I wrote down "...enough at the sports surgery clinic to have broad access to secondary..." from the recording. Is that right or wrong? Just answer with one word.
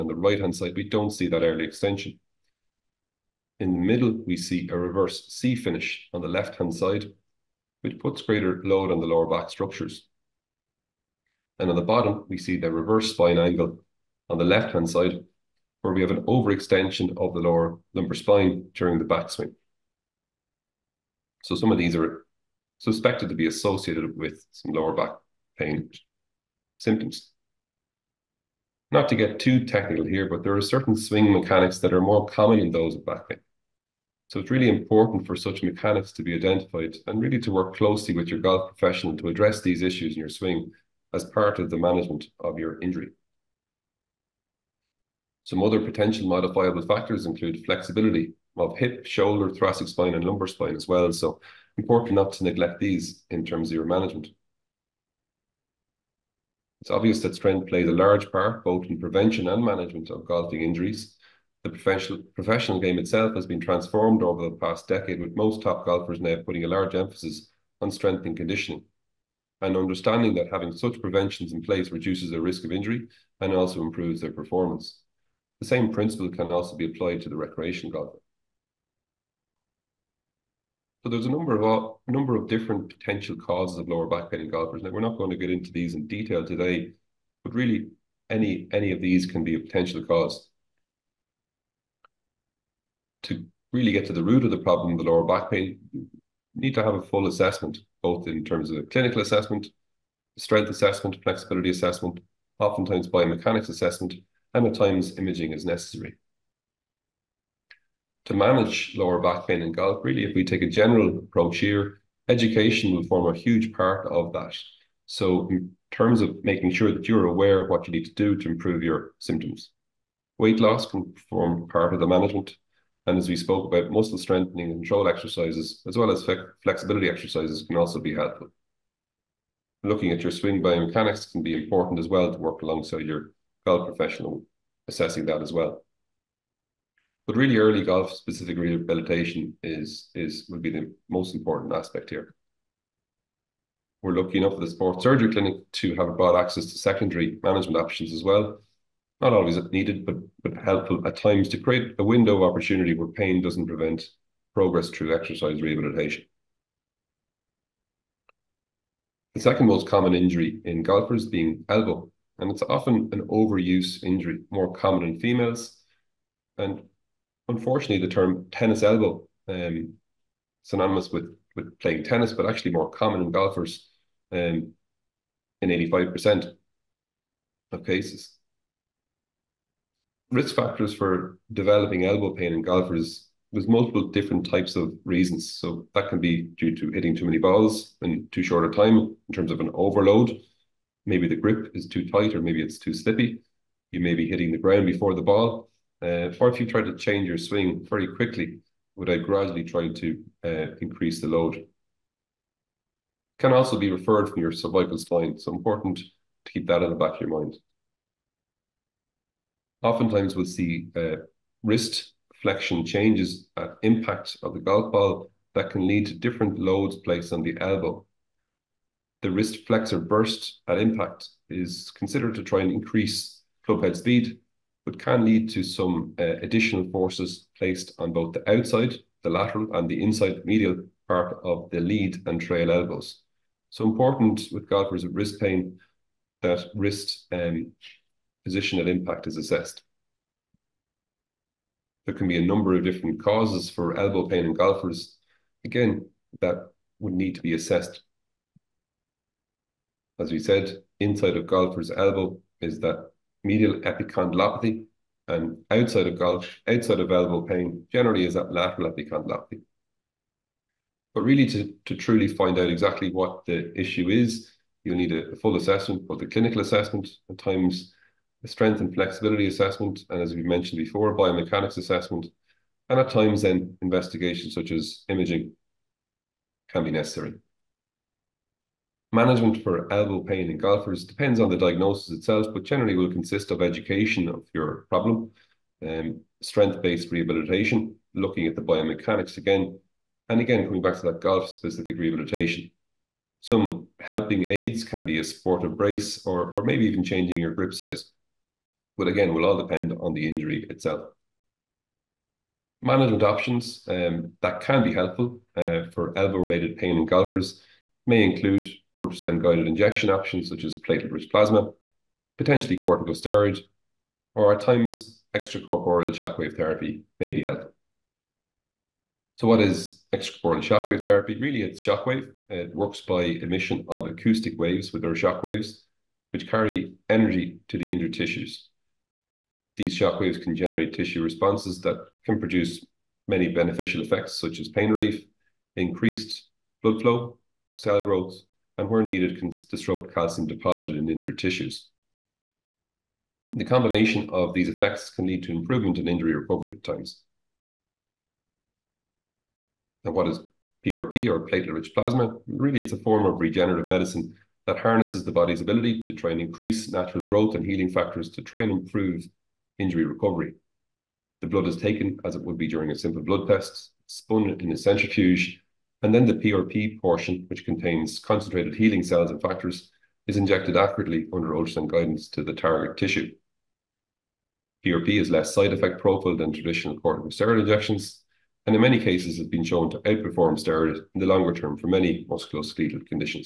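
right.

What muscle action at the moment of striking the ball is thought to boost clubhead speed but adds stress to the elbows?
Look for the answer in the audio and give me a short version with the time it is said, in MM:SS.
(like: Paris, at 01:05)
Wrist flexor burst, at 03:39.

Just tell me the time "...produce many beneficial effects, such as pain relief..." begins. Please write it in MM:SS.
05:32.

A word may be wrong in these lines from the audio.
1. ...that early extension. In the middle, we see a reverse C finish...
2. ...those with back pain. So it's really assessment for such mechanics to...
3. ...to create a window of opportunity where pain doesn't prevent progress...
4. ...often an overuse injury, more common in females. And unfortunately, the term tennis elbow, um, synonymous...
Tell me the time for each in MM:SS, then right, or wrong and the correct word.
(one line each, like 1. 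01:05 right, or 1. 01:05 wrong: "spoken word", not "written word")
1. 00:01 right
2. 00:32 wrong: "important", not "assessment"
3. 02:31 right
4. 02:42 right.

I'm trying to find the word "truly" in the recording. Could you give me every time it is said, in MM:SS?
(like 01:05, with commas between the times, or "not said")
04:21.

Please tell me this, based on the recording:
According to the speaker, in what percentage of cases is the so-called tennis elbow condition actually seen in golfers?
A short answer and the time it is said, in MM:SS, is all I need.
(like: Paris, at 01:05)
85%, at 02:55.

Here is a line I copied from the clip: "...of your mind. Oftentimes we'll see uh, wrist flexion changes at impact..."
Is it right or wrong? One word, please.
right.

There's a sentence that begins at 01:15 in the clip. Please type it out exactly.
The same principle can also be applied to the recreation golfer.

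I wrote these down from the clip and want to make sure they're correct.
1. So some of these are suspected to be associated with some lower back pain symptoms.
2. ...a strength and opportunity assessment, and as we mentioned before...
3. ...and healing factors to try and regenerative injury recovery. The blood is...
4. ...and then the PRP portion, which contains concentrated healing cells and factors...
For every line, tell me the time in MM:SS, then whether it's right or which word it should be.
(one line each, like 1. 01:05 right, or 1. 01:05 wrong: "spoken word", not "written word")
1. 00:21 right
2. 04:28 wrong: "flexibility", not "opportunity"
3. 05:57 wrong: "improve", not "regenerative"
4. 06:06 right.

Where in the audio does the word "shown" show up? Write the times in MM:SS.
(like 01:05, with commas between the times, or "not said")
06:19.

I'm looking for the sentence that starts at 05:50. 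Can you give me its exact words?
And what is PRP or platelet-rich plasma?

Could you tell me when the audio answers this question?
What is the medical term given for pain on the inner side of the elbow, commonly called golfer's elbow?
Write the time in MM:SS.
04:13.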